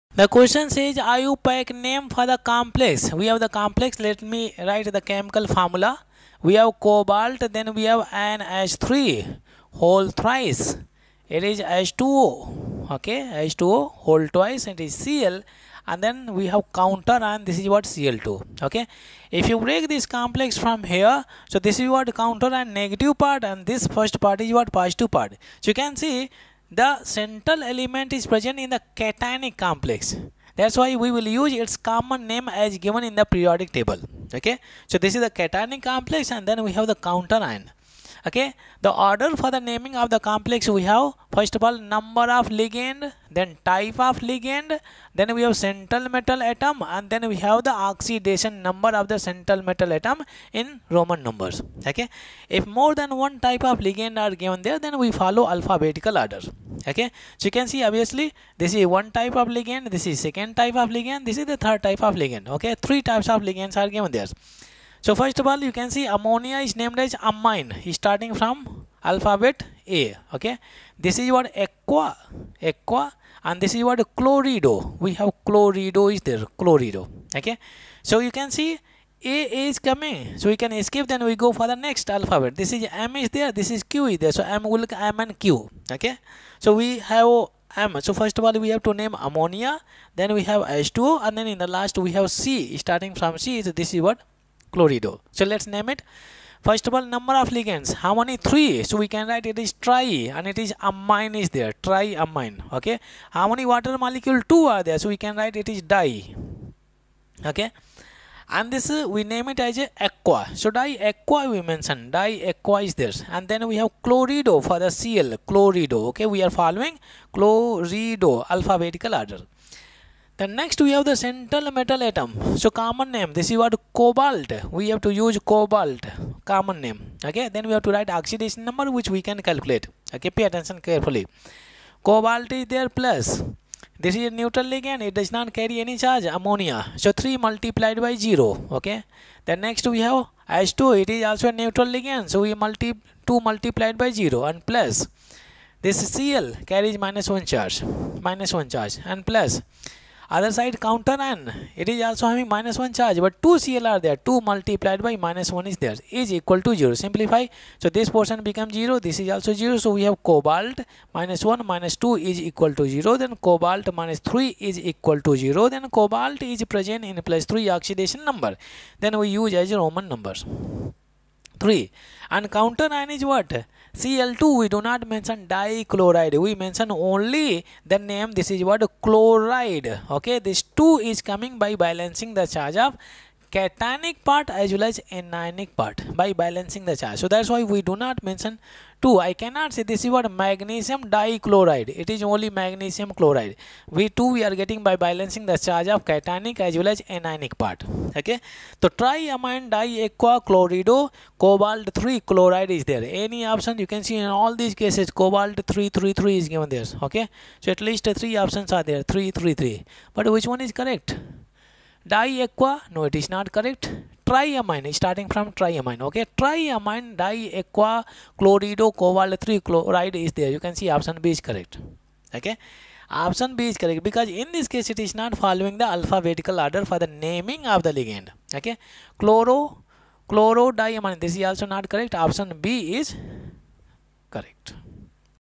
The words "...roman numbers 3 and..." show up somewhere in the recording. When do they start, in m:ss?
2:49.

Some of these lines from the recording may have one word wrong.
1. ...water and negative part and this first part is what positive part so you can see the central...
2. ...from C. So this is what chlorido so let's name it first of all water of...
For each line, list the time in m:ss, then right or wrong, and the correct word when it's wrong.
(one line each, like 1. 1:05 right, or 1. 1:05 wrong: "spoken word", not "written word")
1. 0:22 wrong: "counter", not "water"
2. 1:33 wrong: "number", not "water".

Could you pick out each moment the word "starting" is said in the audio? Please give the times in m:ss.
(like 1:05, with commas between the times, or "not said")
1:07, 1:32, 3:34.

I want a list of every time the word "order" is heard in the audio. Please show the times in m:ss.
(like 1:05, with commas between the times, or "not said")
0:39, 0:56, 1:59, 3:46.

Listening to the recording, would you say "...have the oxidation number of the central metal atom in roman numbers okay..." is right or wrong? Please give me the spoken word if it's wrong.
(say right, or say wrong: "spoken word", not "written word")
right.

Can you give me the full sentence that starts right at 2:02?
So common name, this is what cobalt.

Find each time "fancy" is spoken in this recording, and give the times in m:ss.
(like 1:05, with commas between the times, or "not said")
not said.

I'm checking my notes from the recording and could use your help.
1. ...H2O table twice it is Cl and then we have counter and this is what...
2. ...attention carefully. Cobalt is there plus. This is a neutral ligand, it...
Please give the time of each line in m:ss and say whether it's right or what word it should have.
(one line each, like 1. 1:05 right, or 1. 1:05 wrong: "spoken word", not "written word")
1. 0:13 wrong: "whole", not "table"
2. 2:10 right.